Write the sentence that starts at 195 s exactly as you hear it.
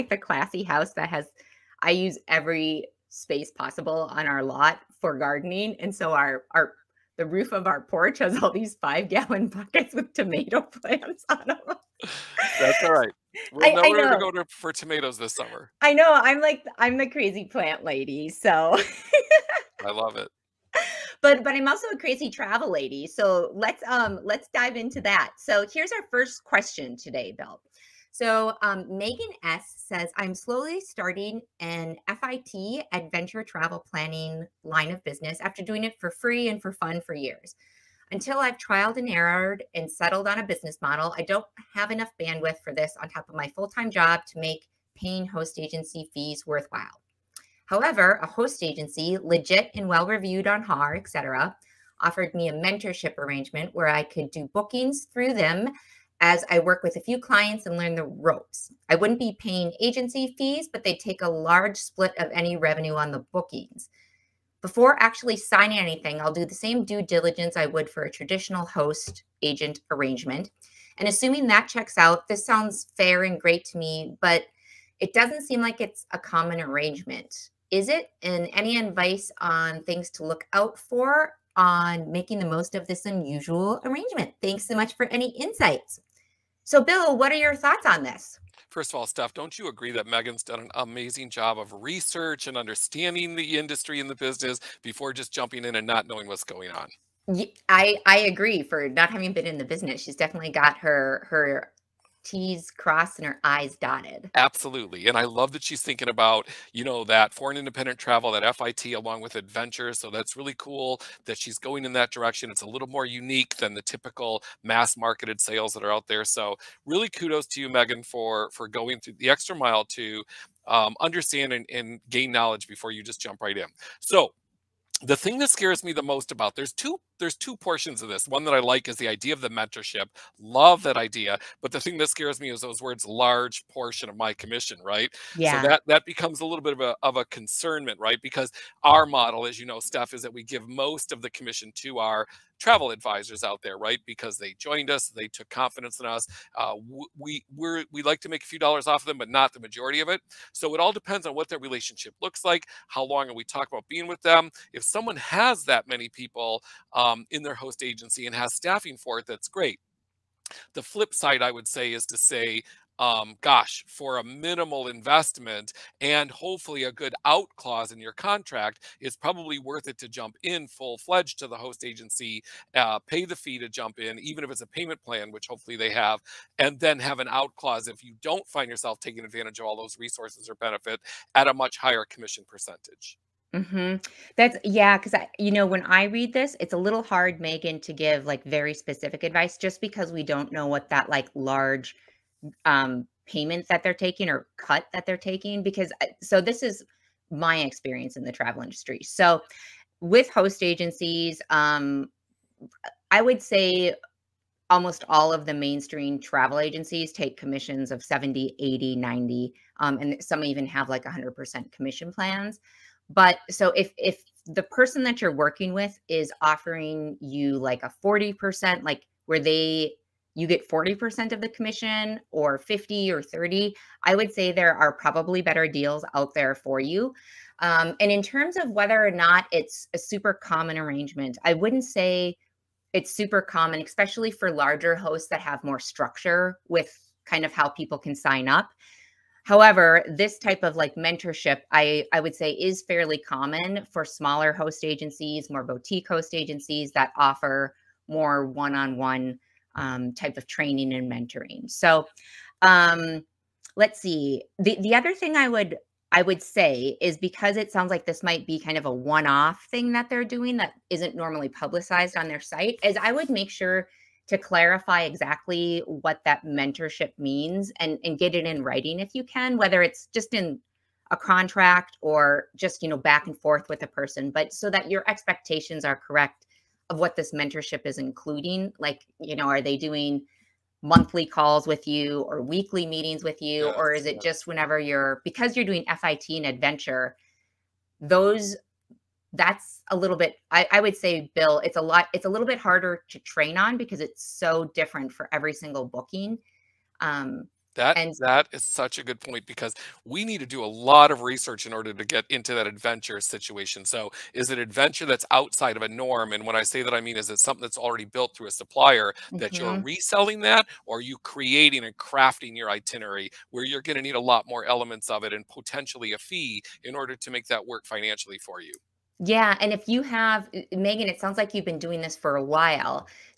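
Because uh, so this is my experience in the travel industry.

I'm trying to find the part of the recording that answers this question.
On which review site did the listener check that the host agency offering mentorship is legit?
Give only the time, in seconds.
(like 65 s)
50 s.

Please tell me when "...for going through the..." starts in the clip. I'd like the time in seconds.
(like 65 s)
118 s.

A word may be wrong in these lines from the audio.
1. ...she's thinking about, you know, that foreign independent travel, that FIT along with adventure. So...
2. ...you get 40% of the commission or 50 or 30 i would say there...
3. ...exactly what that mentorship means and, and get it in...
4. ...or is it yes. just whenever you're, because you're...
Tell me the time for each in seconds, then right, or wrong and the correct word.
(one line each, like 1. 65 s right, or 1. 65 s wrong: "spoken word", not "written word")
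1. 105 s right
2. 220 s right
3. 265 s right
4. 283 s right.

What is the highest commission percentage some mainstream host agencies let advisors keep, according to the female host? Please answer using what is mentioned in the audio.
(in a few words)
100%.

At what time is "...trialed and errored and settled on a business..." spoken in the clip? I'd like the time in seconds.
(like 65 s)
38 s.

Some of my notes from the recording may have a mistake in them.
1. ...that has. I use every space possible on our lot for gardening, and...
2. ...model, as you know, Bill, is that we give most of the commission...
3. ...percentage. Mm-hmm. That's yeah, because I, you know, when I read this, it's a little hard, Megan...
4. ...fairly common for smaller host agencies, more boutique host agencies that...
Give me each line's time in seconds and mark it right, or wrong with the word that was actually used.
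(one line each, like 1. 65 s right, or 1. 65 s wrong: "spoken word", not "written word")
1. 0 s right
2. 139 s wrong: "Steph", not "Bill"
3. 182 s right
4. 242 s right.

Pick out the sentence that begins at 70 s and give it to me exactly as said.
And assuming that checks out, this sounds fair and great to me, but it doesn't seem like it's a common arrangement.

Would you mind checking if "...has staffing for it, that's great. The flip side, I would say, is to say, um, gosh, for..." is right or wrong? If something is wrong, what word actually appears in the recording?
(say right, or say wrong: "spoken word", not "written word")
right.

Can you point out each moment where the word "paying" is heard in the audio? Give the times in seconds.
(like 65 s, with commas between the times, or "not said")
44 s, 59 s.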